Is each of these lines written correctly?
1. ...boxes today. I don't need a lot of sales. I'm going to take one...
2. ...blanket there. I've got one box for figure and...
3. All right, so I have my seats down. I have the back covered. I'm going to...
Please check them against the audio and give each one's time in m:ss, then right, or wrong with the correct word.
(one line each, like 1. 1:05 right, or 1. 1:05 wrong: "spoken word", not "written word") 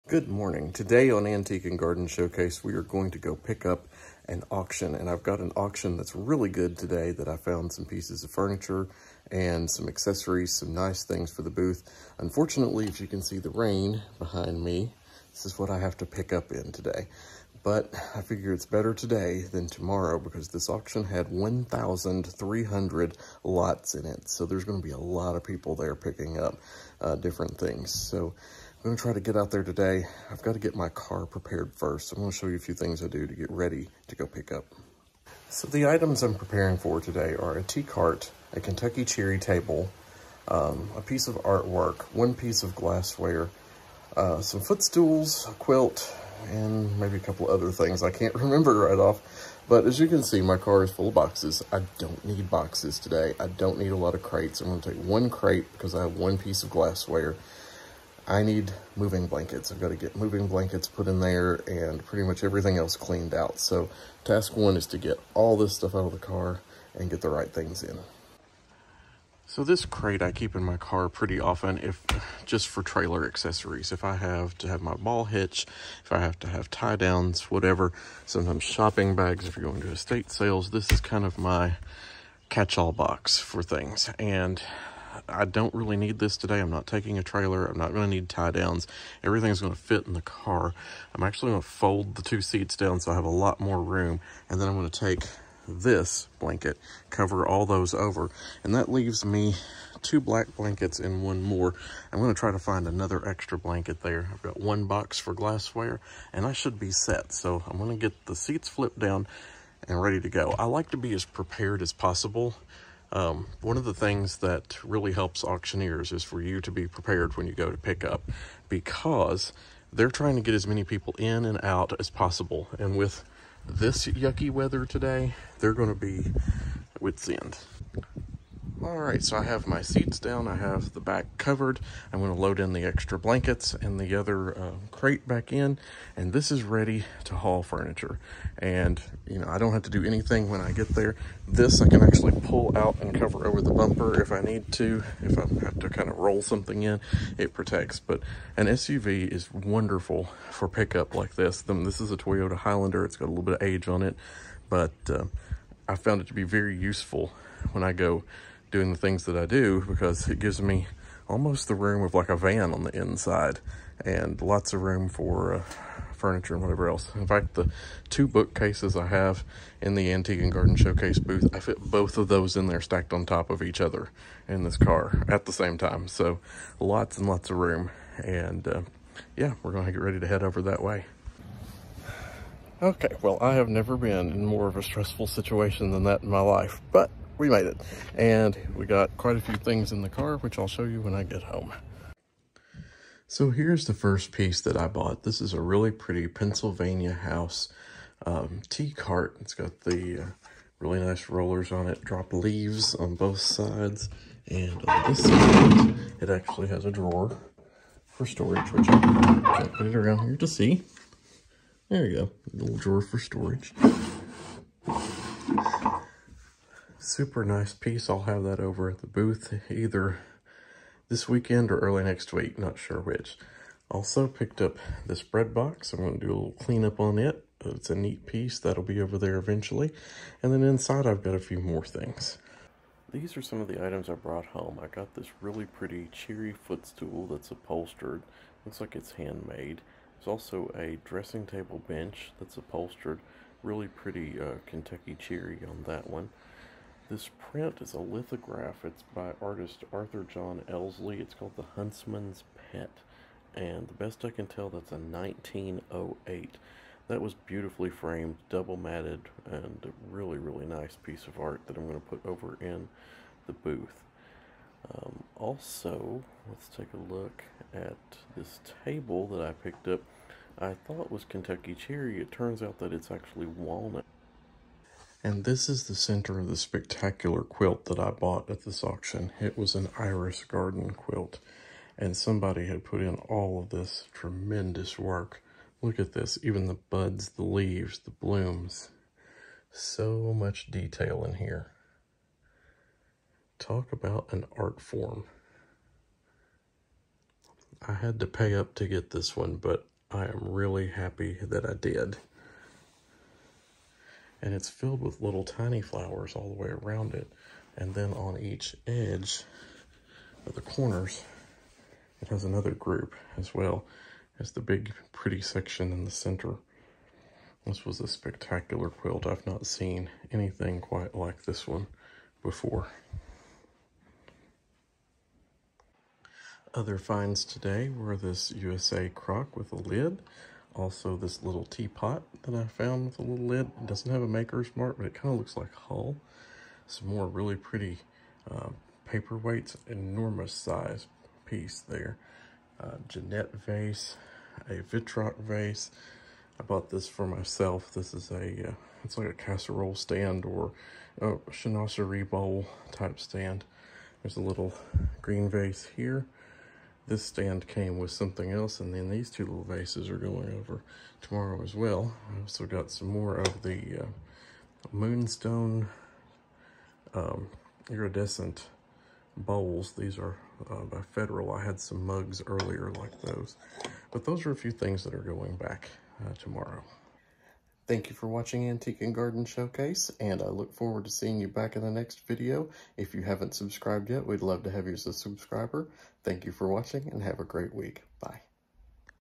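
1. 0:52 wrong: "crates", not "sales"
2. 1:43 wrong: "glassware", not "figure"
3. 2:08 right.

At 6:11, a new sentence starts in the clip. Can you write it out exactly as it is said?
I had some mugs earlier like those.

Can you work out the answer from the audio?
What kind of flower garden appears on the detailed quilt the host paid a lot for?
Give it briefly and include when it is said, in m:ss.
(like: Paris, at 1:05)
Iris, at 4:39.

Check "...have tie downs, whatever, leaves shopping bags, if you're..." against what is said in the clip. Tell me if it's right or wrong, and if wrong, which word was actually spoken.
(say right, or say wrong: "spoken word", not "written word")
wrong: "sometimes", not "leaves".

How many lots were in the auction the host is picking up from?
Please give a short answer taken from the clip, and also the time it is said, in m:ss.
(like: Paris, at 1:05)
1,300, at 0:21.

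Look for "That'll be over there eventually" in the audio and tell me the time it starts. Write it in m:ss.
3:48.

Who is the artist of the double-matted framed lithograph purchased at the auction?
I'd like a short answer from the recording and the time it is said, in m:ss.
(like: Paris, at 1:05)
Arthur John Elsley, at 4:09.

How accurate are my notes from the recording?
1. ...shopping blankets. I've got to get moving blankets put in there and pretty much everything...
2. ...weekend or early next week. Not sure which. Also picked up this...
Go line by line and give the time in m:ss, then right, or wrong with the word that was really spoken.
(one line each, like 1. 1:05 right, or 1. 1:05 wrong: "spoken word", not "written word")
1. 0:58 wrong: "moving", not "shopping"
2. 3:41 right.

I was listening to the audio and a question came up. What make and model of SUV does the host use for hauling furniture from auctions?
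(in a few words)
Toyota Highlander.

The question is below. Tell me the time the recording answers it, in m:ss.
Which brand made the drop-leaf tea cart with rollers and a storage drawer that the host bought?
3:16.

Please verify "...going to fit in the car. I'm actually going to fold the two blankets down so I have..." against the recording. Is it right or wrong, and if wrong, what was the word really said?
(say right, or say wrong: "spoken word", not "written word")
wrong: "seats", not "blankets".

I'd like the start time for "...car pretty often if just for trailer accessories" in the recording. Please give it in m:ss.
1:10.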